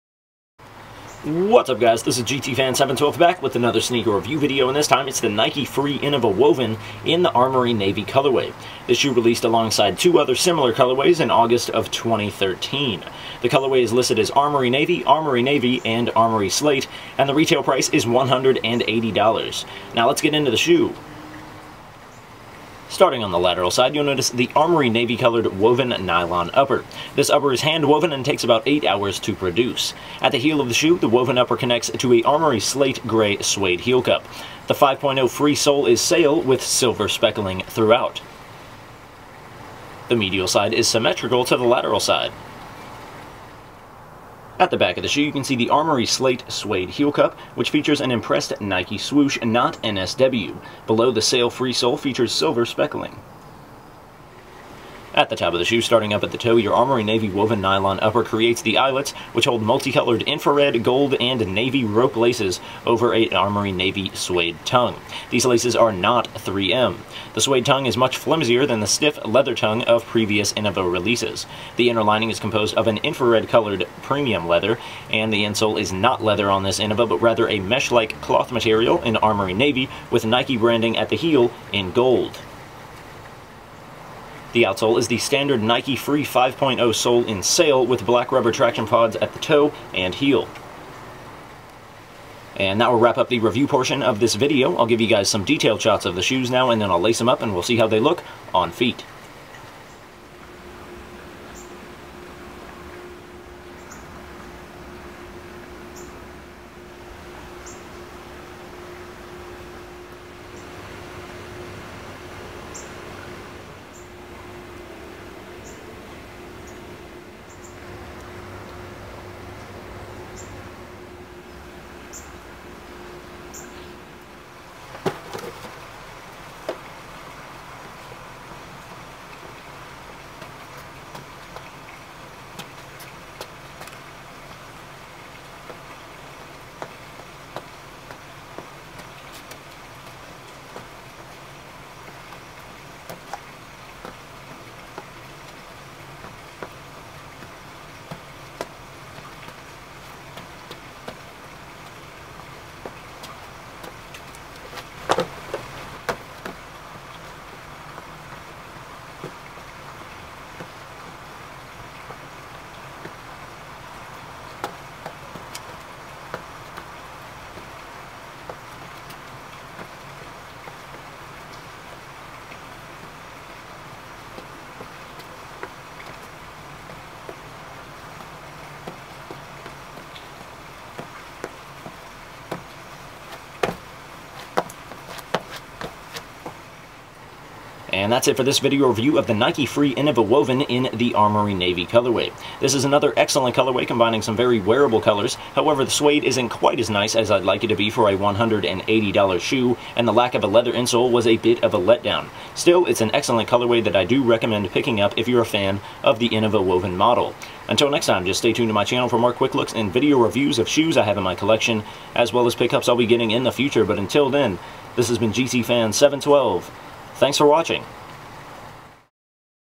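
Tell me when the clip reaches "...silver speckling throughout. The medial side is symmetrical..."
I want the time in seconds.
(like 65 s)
36 s.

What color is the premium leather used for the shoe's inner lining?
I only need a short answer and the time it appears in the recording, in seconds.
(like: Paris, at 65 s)
Infrared, at 72 s.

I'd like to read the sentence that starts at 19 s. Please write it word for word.
Now let's get into the shoe.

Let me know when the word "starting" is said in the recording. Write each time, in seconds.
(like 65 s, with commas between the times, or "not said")
22 s, 55 s.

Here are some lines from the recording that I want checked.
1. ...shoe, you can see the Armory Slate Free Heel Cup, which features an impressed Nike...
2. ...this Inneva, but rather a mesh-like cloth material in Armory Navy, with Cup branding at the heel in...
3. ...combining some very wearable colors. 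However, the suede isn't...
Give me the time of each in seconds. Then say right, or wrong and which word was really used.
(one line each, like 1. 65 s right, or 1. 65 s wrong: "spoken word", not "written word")
1. 45 s wrong: "Suede", not "Free"
2. 76 s wrong: "Nike", not "Cup"
3. 193 s right.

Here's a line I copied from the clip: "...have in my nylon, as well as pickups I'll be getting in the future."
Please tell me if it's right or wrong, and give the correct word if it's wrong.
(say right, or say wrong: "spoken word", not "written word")
wrong: "collection", not "nylon".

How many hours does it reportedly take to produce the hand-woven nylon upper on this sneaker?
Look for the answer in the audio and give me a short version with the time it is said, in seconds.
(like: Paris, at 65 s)
8, at 28 s.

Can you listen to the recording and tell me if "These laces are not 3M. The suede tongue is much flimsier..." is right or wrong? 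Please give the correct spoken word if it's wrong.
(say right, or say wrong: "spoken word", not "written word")
right.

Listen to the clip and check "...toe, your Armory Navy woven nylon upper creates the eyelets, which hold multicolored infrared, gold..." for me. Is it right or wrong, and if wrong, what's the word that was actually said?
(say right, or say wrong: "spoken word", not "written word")
right.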